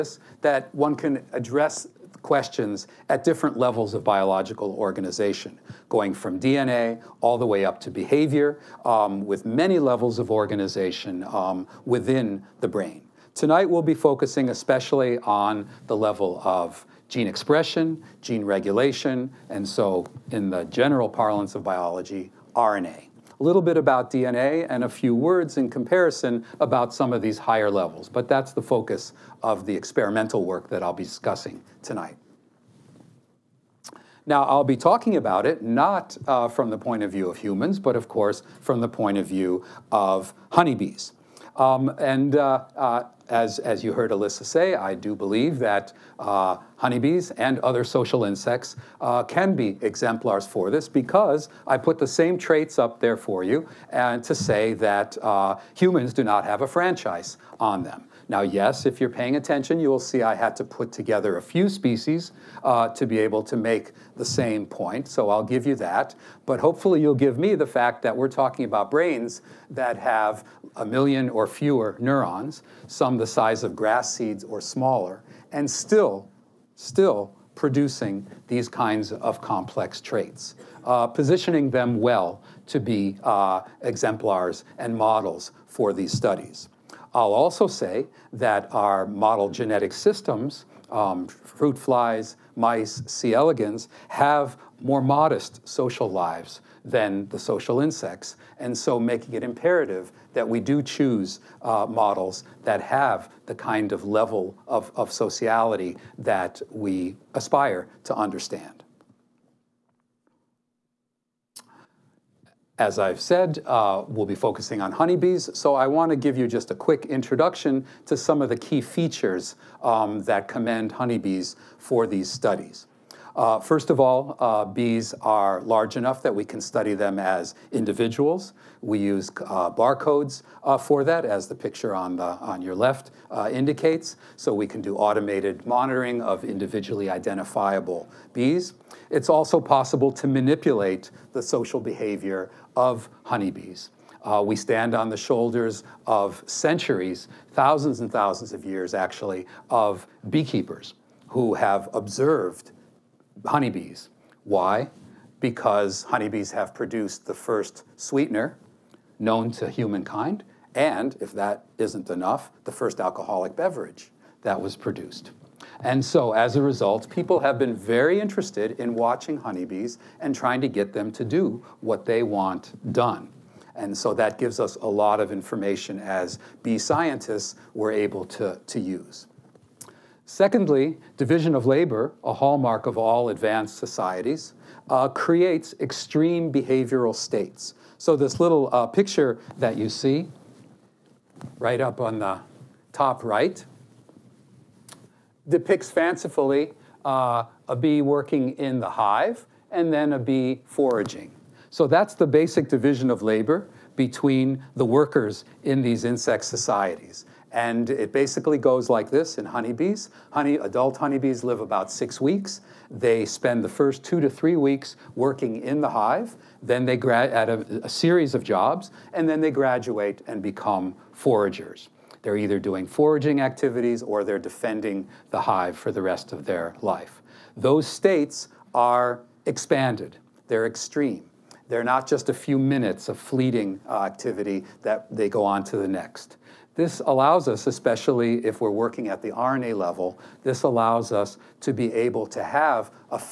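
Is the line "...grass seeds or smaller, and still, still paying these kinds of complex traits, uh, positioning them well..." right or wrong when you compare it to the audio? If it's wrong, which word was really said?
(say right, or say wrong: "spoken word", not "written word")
wrong: "producing", not "paying".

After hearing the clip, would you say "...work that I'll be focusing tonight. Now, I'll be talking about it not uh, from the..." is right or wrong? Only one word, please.
wrong.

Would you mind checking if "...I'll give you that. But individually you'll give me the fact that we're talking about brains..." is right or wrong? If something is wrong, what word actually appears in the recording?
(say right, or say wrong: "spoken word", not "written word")
wrong: "hopefully", not "individually".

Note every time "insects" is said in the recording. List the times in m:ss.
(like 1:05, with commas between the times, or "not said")
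0:48, 1:37, 3:26.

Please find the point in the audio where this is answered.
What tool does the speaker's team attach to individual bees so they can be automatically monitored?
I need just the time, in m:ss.
2:09.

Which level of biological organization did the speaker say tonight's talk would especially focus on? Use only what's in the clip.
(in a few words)
Gene expression.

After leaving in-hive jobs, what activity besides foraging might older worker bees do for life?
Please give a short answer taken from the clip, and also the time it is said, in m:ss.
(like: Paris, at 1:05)
Defending the hive, at 3:44.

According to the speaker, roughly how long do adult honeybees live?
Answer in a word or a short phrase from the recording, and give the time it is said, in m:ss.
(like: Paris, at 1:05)
About 6 weeks, at 3:31.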